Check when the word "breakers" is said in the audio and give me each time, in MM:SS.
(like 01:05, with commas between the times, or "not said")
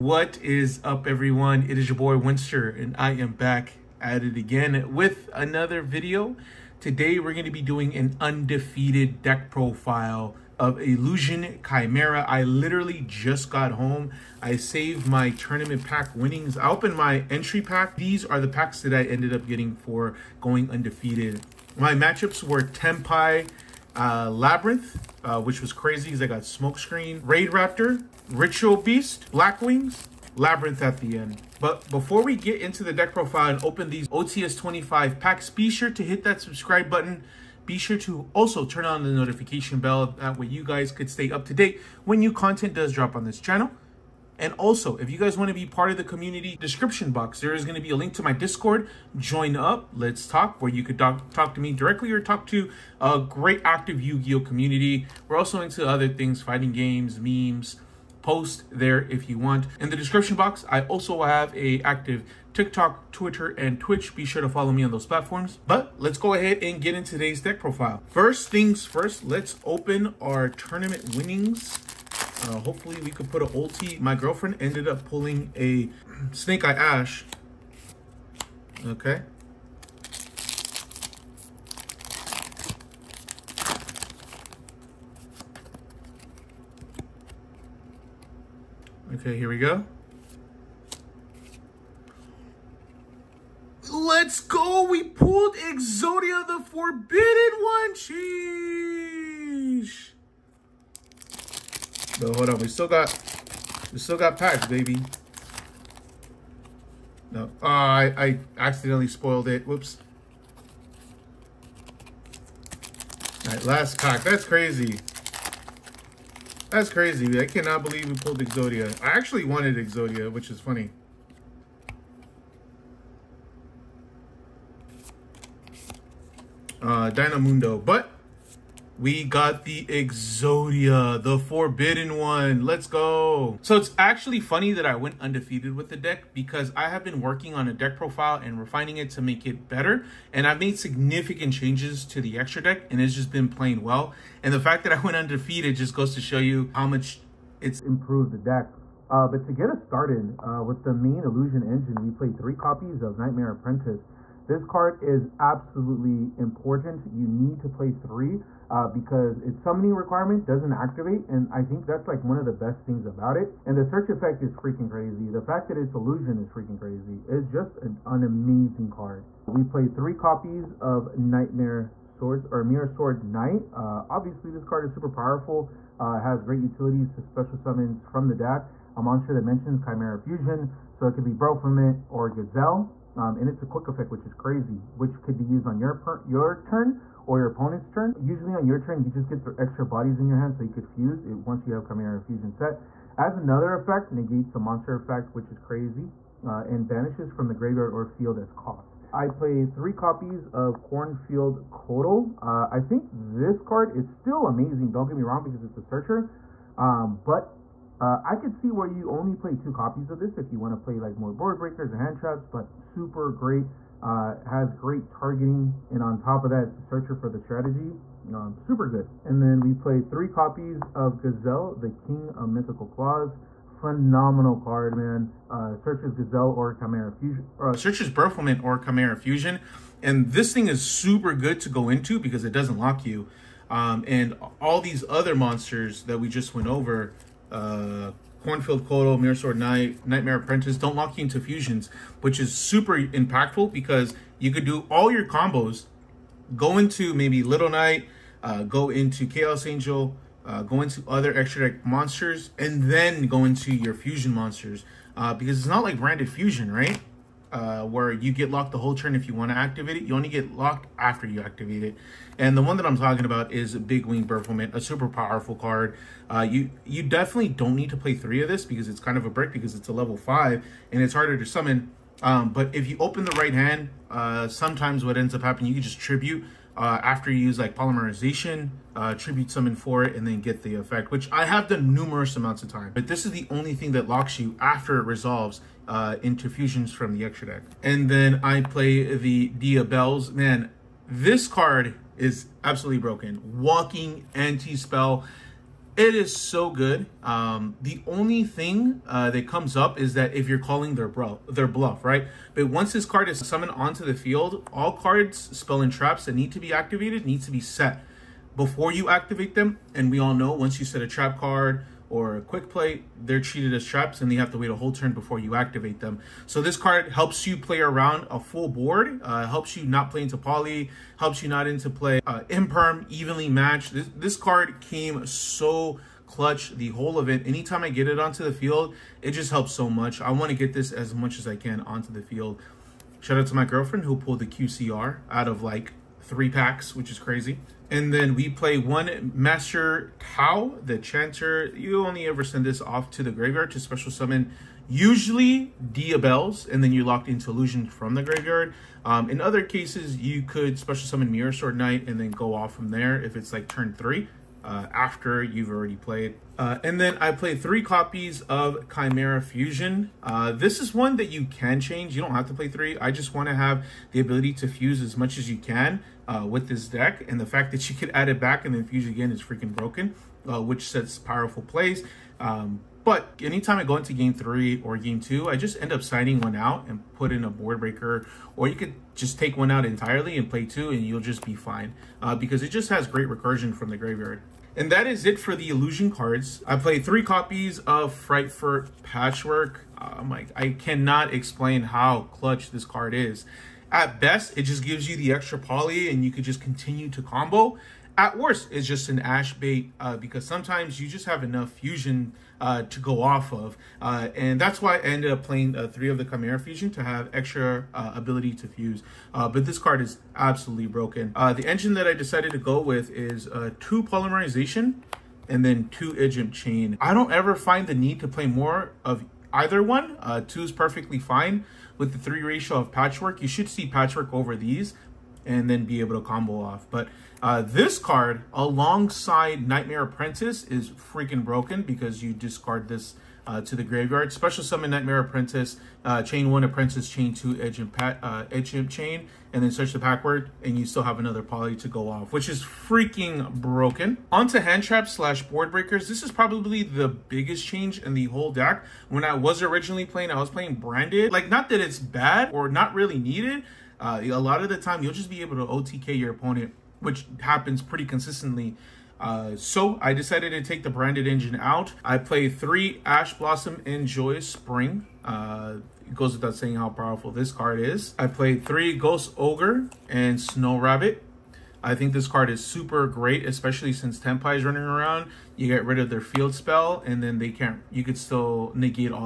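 03:31, 06:17, 07:25.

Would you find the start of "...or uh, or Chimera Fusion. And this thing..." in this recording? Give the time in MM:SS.
03:47.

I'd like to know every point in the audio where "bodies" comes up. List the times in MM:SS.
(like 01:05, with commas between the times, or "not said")
03:09.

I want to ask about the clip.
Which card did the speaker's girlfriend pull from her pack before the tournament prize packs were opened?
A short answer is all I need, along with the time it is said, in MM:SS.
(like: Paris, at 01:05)
Snake Eye Ash, at 01:16.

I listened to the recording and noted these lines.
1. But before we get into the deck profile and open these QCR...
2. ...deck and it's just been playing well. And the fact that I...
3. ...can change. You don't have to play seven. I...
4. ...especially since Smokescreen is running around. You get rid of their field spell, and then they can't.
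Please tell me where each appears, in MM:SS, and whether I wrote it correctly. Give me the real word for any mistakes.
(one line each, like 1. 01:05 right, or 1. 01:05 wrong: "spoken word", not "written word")
1. 00:31 wrong: "OTS", not "QCR"
2. 02:22 right
3. 06:01 wrong: "three", not "seven"
4. 07:53 wrong: "Tenpai", not "Smokescreen".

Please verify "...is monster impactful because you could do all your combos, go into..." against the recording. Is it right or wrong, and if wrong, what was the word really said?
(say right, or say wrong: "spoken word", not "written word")
wrong: "super", not "monster".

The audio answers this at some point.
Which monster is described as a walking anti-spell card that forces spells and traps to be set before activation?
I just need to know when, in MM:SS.
04:49.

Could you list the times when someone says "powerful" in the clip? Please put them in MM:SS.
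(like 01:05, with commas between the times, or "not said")
02:55, 04:25, 06:11, 07:46.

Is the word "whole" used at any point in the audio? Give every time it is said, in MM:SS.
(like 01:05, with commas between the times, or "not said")
04:18, 05:14, 05:26, 07:28.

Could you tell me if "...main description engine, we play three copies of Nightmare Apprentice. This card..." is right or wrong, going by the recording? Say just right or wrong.
wrong.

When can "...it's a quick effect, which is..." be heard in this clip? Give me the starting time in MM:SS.
03:03.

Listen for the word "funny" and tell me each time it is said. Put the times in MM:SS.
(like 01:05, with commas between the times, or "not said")
02:00, 02:14.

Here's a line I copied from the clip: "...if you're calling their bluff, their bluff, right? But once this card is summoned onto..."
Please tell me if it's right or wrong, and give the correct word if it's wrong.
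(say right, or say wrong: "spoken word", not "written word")
right.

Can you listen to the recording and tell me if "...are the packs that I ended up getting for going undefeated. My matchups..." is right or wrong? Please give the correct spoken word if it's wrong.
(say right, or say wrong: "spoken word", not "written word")
right.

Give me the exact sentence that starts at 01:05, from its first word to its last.
But let's go ahead and get into today's deck profile.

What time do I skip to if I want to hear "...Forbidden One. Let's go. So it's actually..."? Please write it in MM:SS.
02:11.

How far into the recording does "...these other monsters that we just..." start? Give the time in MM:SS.
03:54.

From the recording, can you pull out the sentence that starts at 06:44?
Uh, and that's why I ended up playing uh, three of the Chimera Fusion to have extra uh, ability to fuse.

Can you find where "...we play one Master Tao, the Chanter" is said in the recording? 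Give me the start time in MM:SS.
05:38.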